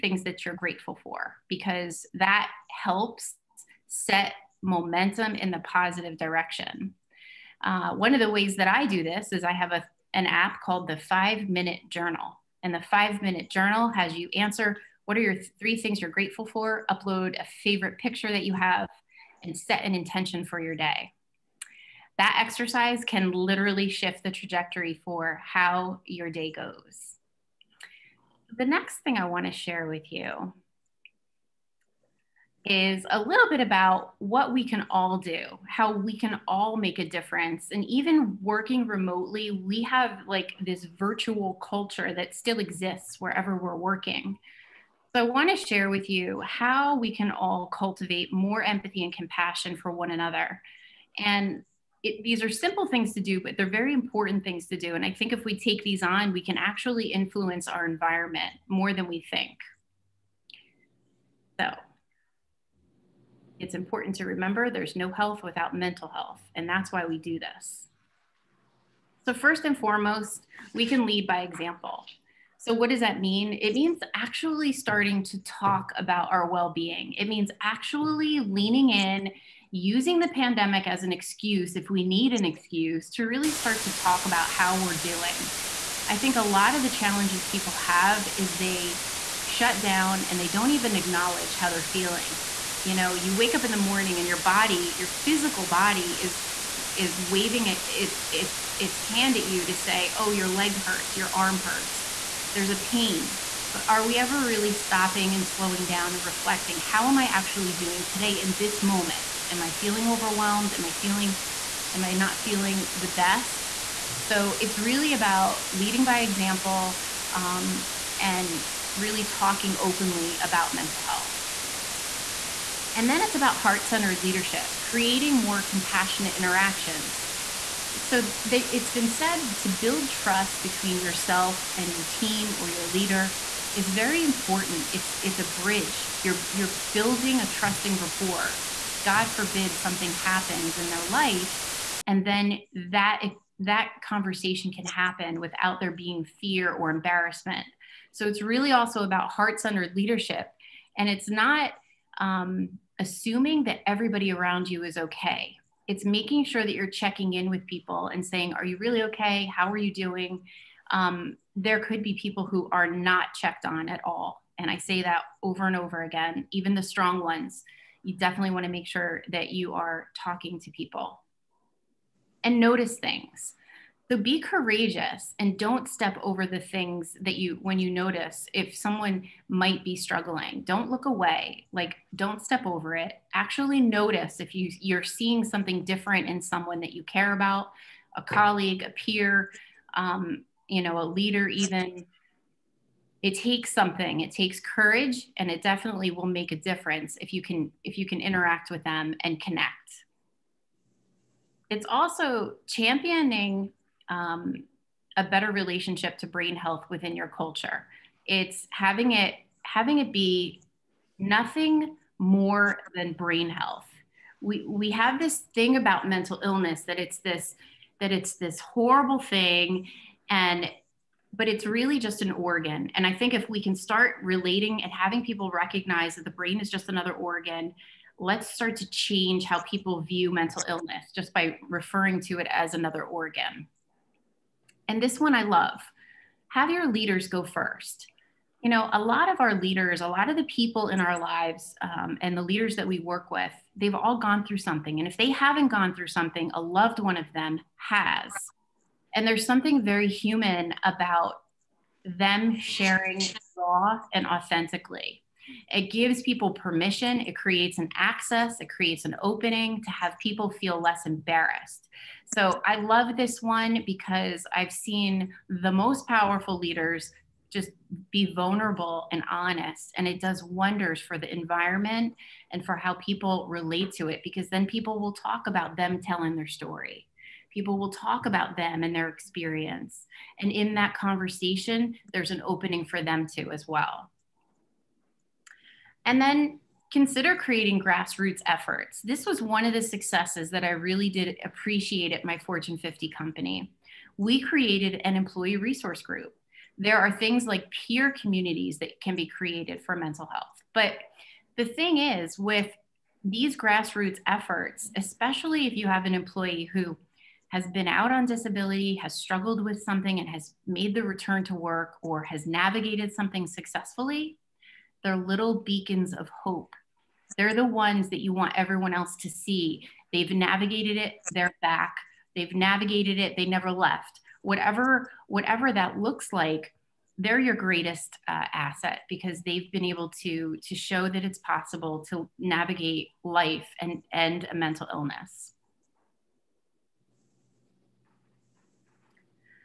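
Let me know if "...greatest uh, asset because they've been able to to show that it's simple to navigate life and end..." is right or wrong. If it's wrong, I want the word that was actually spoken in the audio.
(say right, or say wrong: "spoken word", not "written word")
wrong: "possible", not "simple".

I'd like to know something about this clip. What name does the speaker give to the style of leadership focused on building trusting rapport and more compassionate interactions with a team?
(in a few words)
heart-centered leadership.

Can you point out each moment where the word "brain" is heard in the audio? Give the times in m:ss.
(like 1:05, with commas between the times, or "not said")
3:26, 3:33, 3:46.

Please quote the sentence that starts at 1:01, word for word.
So it's important to remember there's no health without mental health.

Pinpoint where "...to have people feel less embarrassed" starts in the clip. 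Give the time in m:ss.
4:19.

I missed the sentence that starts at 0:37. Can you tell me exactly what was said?
And even working remotely, we have like this virtual culture that still exists wherever we're working.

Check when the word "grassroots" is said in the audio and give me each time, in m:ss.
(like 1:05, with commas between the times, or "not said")
4:47, 5:03.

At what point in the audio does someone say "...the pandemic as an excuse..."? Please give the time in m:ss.
1:20.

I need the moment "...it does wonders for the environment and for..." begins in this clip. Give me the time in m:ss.
4:30.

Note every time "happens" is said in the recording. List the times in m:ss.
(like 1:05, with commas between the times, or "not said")
2:20, 2:24.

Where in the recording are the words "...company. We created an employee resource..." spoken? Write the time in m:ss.
4:53.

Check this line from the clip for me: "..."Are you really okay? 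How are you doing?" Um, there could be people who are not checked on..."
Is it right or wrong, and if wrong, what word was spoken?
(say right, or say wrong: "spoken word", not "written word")
right.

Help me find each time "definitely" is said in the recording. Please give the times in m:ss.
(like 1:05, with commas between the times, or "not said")
2:48, 3:15.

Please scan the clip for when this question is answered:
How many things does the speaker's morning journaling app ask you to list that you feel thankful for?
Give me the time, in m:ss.
0:15.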